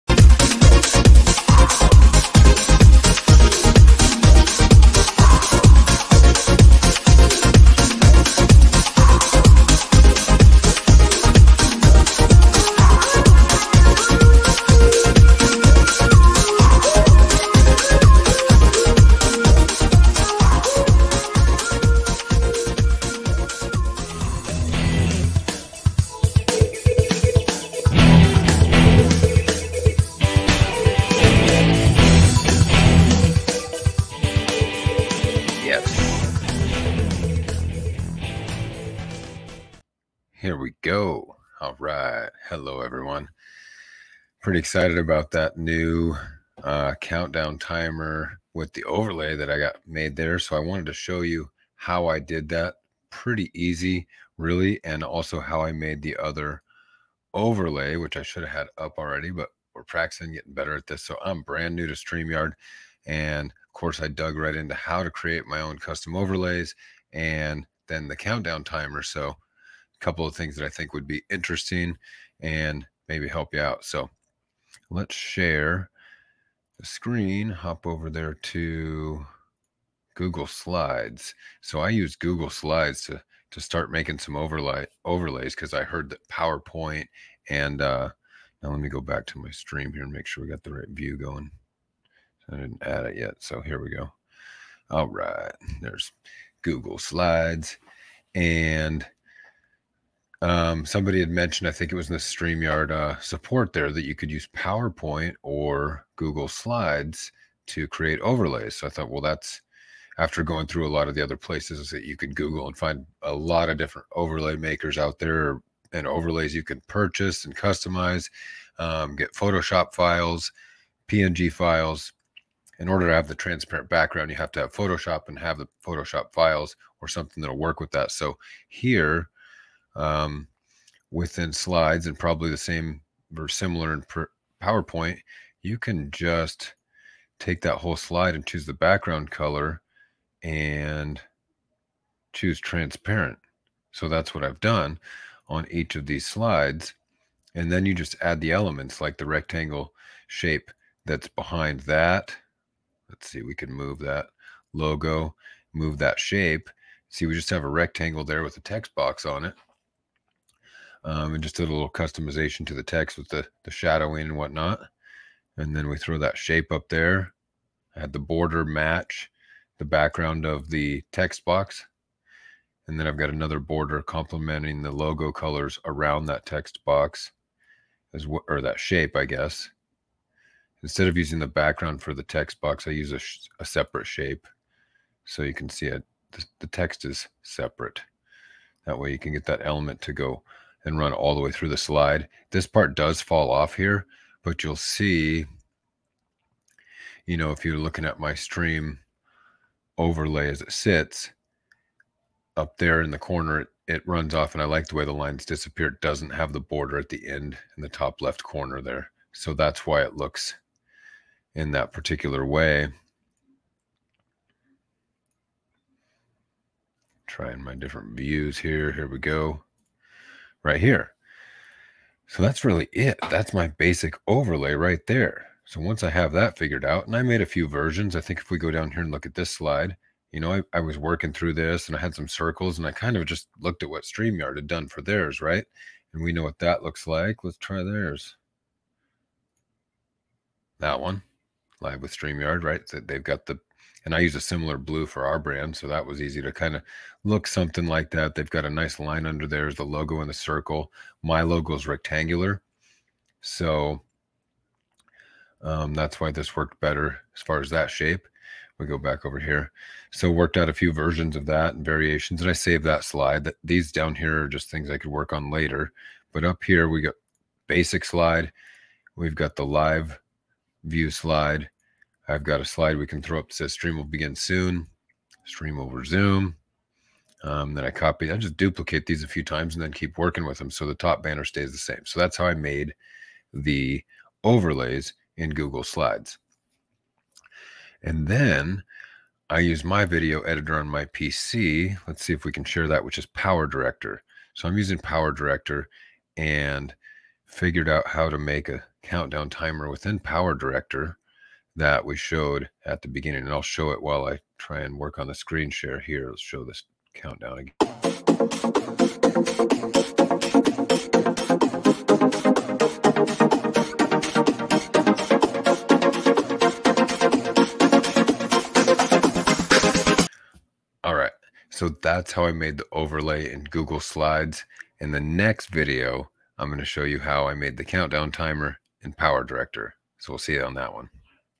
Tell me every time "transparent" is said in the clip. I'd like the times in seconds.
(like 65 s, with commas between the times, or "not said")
123 s, 142 s.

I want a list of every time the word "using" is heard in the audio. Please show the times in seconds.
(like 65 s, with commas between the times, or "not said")
181 s, 294 s.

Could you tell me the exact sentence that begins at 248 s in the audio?
They've got a nice line under there is the logo in the circle.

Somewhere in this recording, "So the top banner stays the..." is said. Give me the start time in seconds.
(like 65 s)
280 s.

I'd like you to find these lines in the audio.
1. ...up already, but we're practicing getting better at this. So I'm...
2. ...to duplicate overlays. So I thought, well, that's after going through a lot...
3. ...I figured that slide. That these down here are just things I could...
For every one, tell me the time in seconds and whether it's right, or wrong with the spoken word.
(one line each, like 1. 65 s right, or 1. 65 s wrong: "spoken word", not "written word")
1. 58 s right
2. 107 s wrong: "create", not "duplicate"
3. 262 s wrong: "saved", not "figured".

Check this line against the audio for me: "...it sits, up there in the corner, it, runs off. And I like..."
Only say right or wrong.
right.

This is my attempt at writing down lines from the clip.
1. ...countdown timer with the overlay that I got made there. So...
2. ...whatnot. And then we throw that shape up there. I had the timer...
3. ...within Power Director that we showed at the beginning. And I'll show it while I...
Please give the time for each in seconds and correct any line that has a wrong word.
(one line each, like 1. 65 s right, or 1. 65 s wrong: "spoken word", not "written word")
1. 47 s right
2. 164 s wrong: "border", not "timer"
3. 299 s right.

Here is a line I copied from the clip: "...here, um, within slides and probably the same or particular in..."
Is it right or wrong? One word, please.
wrong.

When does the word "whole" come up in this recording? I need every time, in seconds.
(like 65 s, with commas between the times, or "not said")
137 s.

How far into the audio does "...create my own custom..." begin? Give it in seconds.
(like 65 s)
65 s.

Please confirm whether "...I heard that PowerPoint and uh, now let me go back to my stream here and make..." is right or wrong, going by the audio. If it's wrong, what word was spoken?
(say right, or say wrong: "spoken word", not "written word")
right.